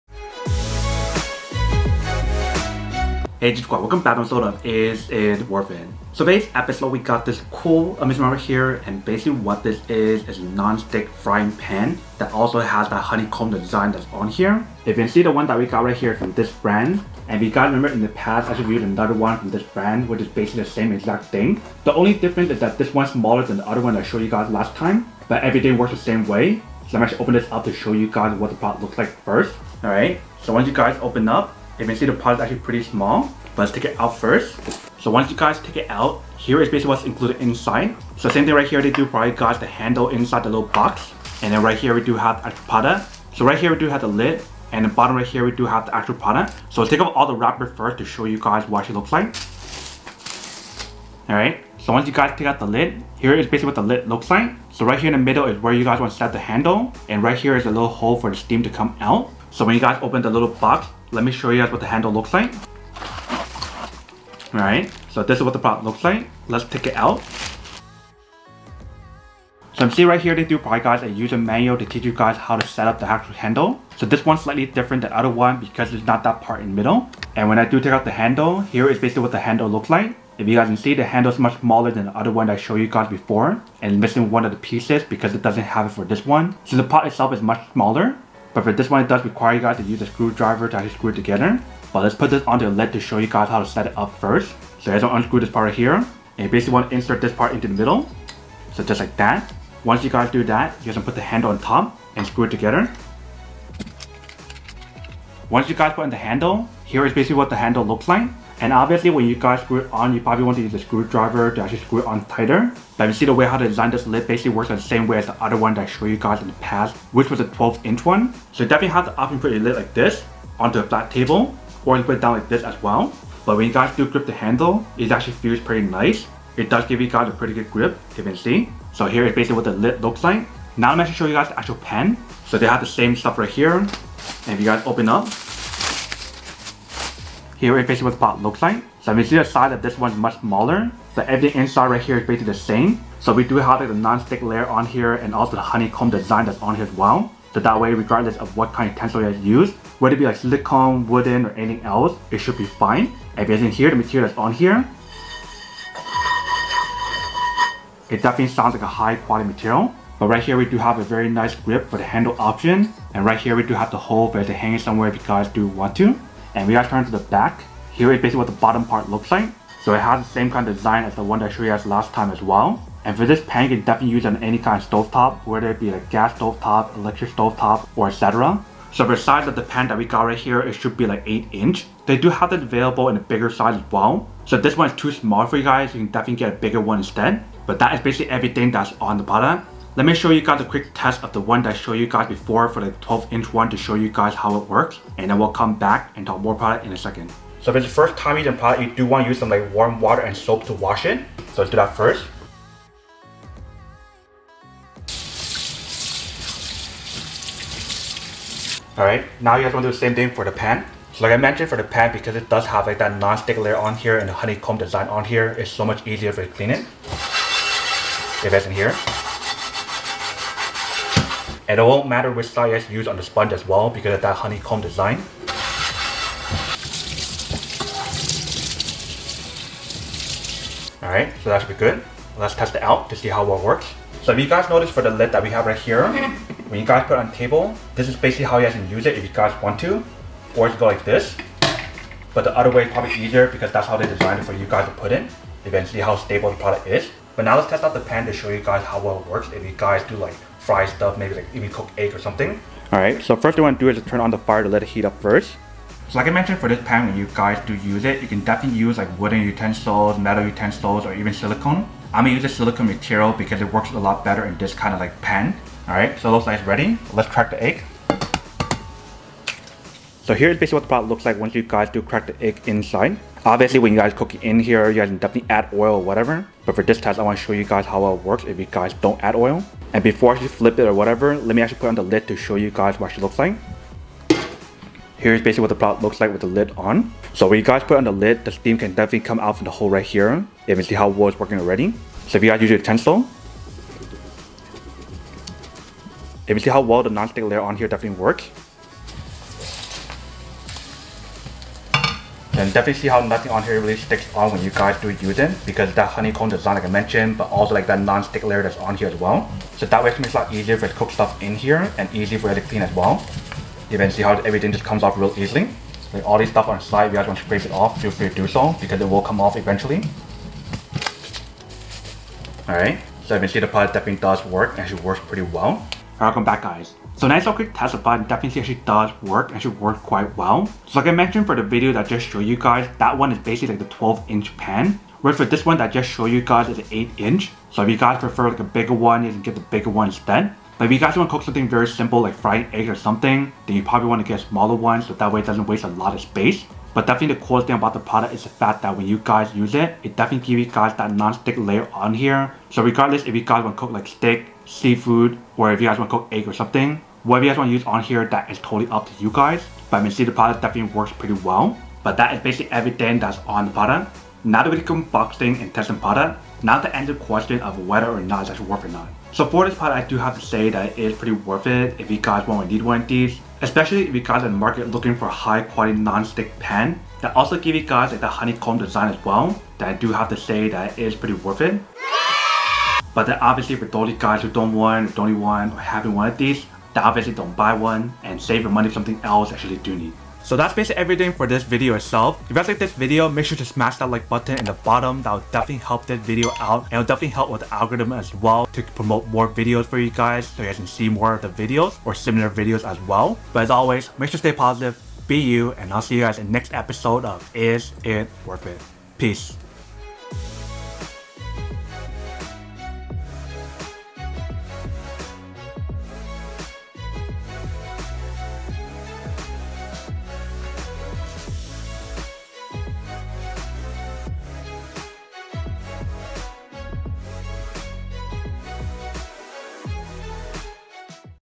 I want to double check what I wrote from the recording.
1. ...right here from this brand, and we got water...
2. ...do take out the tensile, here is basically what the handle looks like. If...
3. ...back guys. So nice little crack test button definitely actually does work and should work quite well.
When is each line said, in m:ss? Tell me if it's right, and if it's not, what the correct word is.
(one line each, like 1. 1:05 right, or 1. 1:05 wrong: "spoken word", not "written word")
1. 0:15 wrong: "remember", not "water"
2. 1:17 wrong: "handle", not "tensile"
3. 5:26 wrong: "quick", not "crack".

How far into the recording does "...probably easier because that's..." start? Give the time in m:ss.
4:02.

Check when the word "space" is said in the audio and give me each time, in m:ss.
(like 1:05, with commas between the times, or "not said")
5:46.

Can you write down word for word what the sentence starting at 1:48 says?
And obviously when you guys screw it on, you probably want to use a screwdriver to actually screw it on tighter.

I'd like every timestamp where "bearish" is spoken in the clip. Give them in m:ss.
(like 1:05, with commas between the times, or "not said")
not said.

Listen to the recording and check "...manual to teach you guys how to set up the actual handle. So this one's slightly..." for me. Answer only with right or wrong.
right.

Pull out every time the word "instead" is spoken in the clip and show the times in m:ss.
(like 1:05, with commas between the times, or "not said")
3:06, 5:40.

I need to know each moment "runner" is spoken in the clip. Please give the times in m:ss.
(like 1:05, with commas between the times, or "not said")
not said.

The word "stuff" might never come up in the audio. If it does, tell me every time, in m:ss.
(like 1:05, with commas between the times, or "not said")
2:13, 4:10, 5:11, 5:16.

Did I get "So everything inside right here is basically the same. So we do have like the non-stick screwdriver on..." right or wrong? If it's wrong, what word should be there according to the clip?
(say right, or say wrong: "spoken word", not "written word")
wrong: "layer", not "screwdriver".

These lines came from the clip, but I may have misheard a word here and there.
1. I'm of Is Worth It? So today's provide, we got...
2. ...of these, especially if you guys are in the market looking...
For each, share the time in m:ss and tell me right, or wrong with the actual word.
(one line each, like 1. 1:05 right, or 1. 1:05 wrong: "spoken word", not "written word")
1. 0:04 wrong: "episode", not "provide"
2. 6:13 right.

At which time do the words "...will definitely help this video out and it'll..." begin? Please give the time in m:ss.
6:35.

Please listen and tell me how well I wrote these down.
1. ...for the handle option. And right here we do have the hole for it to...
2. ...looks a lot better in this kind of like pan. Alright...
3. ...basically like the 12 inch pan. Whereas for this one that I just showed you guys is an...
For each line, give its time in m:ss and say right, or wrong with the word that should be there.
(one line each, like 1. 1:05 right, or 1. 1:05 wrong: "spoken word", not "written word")
1. 2:41 right
2. 4:23 wrong: "works", not "looks"
3. 5:33 right.